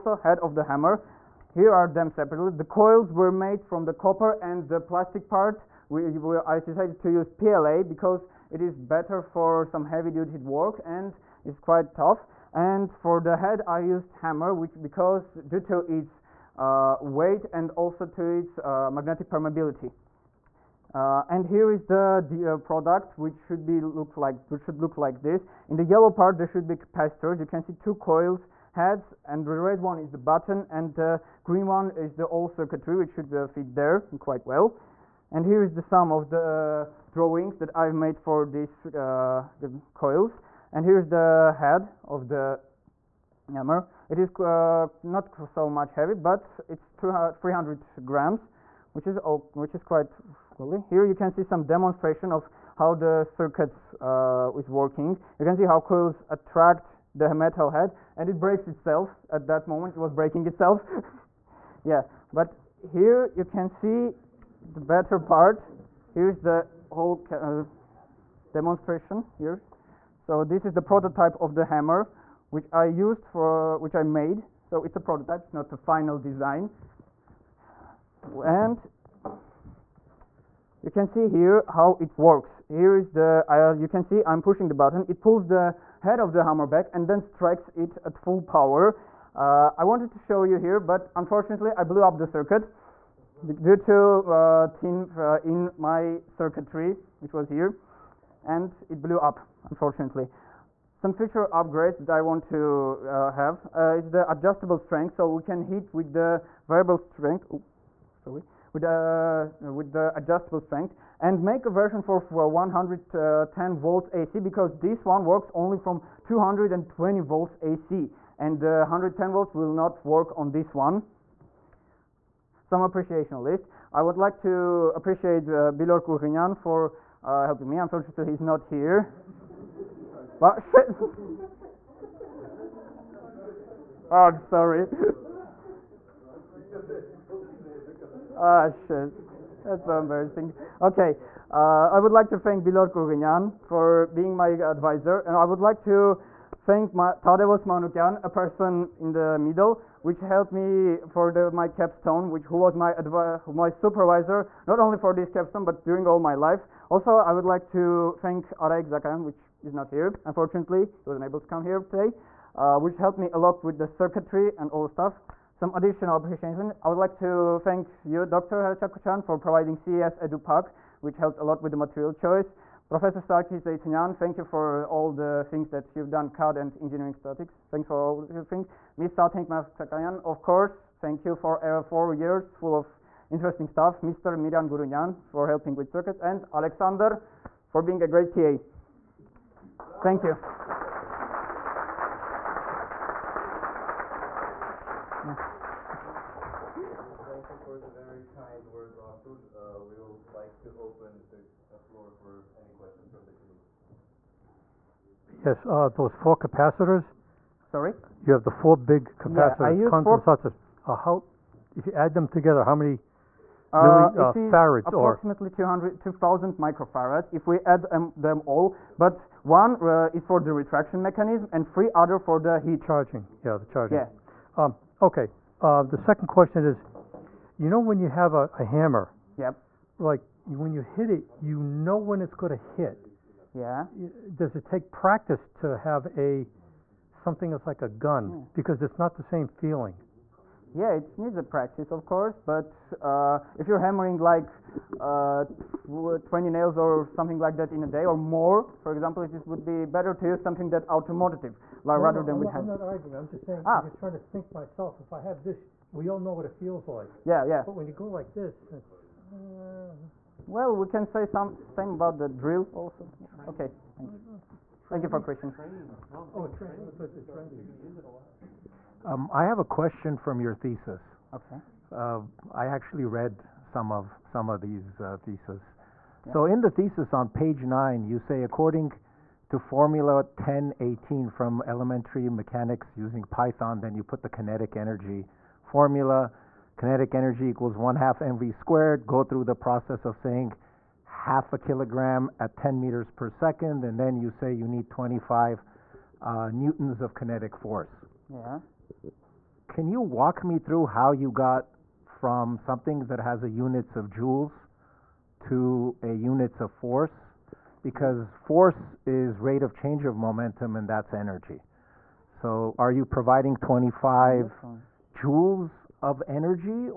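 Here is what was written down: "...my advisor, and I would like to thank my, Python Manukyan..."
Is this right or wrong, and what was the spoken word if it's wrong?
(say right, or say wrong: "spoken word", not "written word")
wrong: "Tadevos", not "Python".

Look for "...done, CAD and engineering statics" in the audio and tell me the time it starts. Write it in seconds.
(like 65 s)
176 s.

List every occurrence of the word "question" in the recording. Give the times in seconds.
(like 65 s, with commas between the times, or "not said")
226 s, 265 s, 269 s.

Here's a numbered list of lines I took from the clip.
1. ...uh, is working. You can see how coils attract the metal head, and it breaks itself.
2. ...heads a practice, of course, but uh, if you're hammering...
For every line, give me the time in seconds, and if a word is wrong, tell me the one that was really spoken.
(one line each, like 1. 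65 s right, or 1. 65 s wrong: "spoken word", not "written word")
1. 53 s right
2. 241 s wrong: "needs", not "heads".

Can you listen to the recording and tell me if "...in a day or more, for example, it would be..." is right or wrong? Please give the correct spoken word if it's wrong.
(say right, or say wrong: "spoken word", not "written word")
right.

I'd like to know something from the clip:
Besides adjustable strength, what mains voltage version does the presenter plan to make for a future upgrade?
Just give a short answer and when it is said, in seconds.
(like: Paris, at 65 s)
110 volts AC, at 112 s.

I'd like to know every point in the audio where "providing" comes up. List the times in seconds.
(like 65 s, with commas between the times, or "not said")
169 s, 313 s.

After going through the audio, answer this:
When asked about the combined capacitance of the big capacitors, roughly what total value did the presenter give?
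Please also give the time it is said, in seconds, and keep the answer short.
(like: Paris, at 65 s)
2000 microfarads, at 215 s.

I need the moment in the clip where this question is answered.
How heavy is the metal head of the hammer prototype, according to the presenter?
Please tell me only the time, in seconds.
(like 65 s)
47 s.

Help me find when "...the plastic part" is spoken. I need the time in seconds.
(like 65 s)
4 s.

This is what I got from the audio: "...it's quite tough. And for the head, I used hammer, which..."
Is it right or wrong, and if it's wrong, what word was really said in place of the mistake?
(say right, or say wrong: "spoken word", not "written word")
right.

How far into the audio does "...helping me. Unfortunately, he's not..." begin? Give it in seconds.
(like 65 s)
127 s.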